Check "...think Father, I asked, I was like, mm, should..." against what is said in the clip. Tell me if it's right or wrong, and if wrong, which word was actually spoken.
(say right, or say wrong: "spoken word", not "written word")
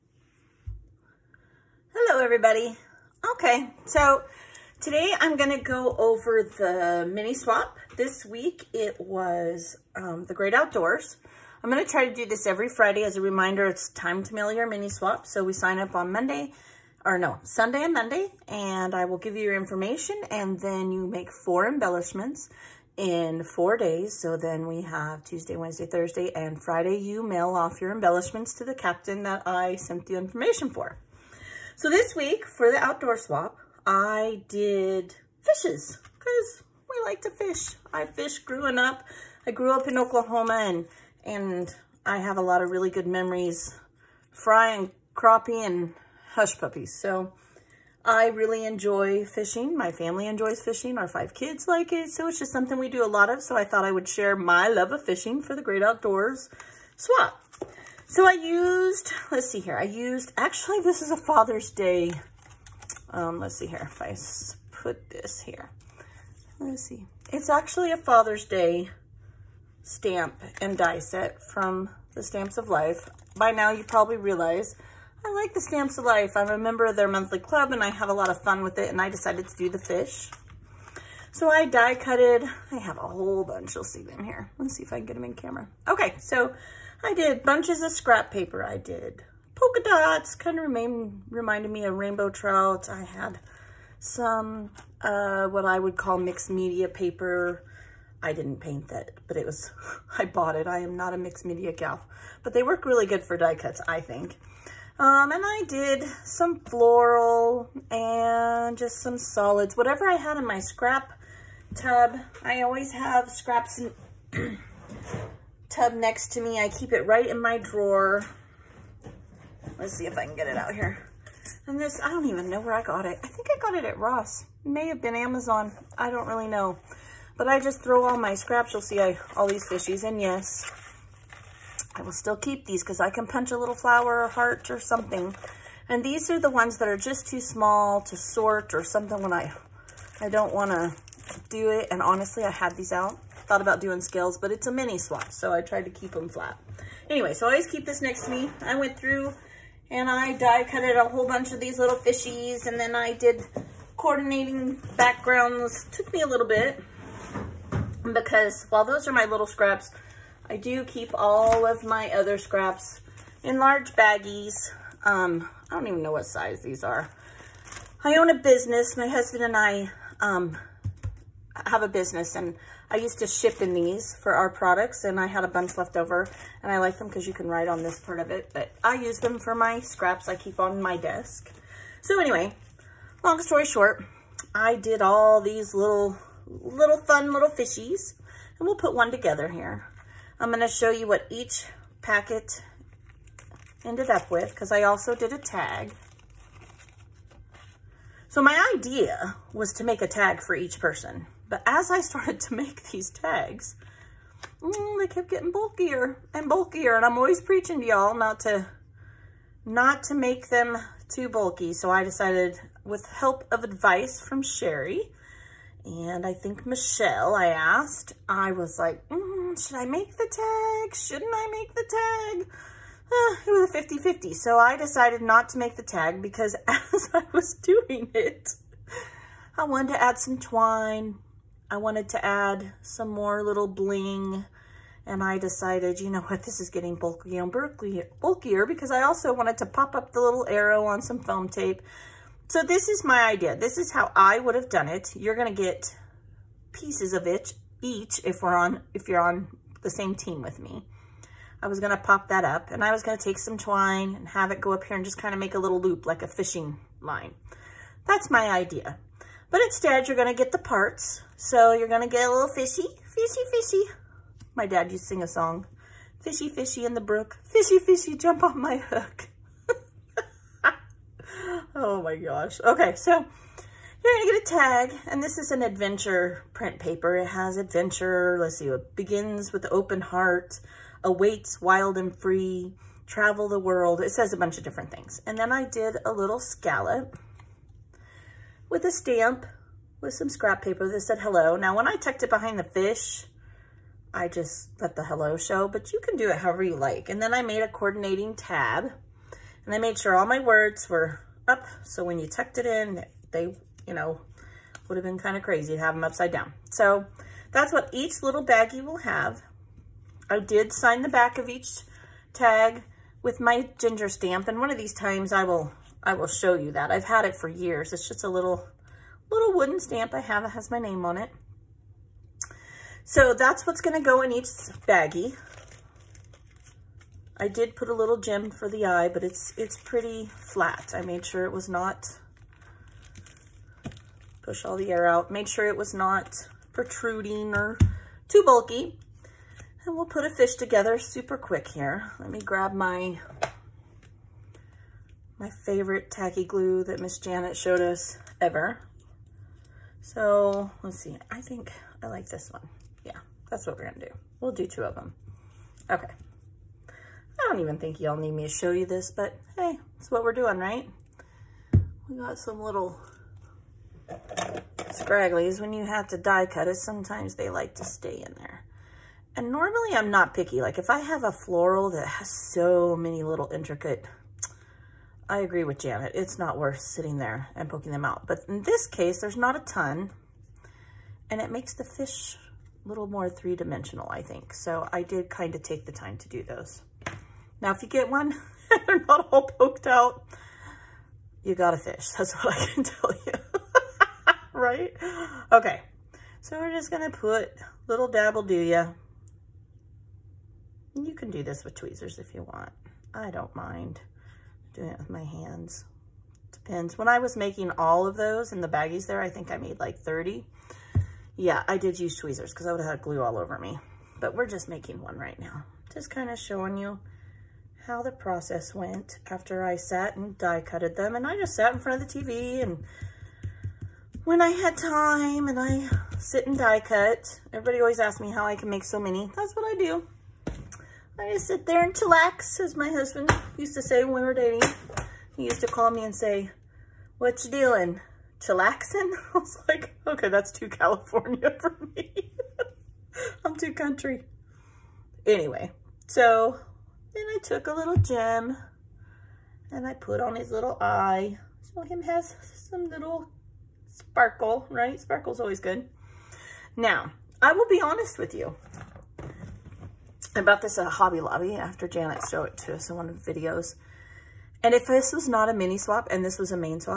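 wrong: "Michelle", not "Father".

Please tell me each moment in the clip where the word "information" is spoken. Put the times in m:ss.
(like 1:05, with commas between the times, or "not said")
0:19, 0:30.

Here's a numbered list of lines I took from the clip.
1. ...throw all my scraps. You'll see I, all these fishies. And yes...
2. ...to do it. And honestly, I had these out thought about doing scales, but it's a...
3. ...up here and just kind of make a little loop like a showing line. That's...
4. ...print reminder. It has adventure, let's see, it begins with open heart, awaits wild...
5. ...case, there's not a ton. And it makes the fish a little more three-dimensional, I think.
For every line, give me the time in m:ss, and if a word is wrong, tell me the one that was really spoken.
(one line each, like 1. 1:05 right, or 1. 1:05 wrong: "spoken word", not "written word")
1. 2:07 right
2. 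2:20 right
3. 4:14 wrong: "fishing", not "showing"
4. 4:36 wrong: "paper", not "reminder"
5. 6:18 right.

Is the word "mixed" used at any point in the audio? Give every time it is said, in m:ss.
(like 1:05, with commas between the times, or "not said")
1:36, 1:41.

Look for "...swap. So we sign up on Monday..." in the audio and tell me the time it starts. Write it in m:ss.
0:14.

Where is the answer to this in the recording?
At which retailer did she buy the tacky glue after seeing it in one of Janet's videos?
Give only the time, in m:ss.
7:40.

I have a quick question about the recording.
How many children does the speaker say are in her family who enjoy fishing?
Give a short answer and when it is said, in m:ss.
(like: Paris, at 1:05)
5, at 0:51.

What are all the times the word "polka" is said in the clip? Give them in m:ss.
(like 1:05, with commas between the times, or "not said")
1:29.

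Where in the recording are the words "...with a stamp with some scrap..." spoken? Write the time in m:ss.
4:48.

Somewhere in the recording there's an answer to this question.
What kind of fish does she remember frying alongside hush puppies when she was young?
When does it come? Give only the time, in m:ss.
0:45.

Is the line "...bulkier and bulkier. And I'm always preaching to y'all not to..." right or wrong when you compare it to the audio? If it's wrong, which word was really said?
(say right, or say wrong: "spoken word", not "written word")
right.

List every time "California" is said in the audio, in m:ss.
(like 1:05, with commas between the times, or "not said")
7:20.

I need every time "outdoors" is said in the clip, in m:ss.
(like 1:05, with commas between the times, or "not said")
0:10, 0:32, 0:55.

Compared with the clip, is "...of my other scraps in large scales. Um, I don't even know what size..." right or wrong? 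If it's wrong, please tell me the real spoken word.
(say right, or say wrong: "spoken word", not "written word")
wrong: "baggies", not "scales".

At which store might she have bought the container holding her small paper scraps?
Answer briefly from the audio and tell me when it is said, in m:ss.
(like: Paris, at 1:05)
Ross, at 2:03.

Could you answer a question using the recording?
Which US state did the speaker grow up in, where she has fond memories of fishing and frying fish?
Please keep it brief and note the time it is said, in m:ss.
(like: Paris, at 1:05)
Oklahoma, at 0:39.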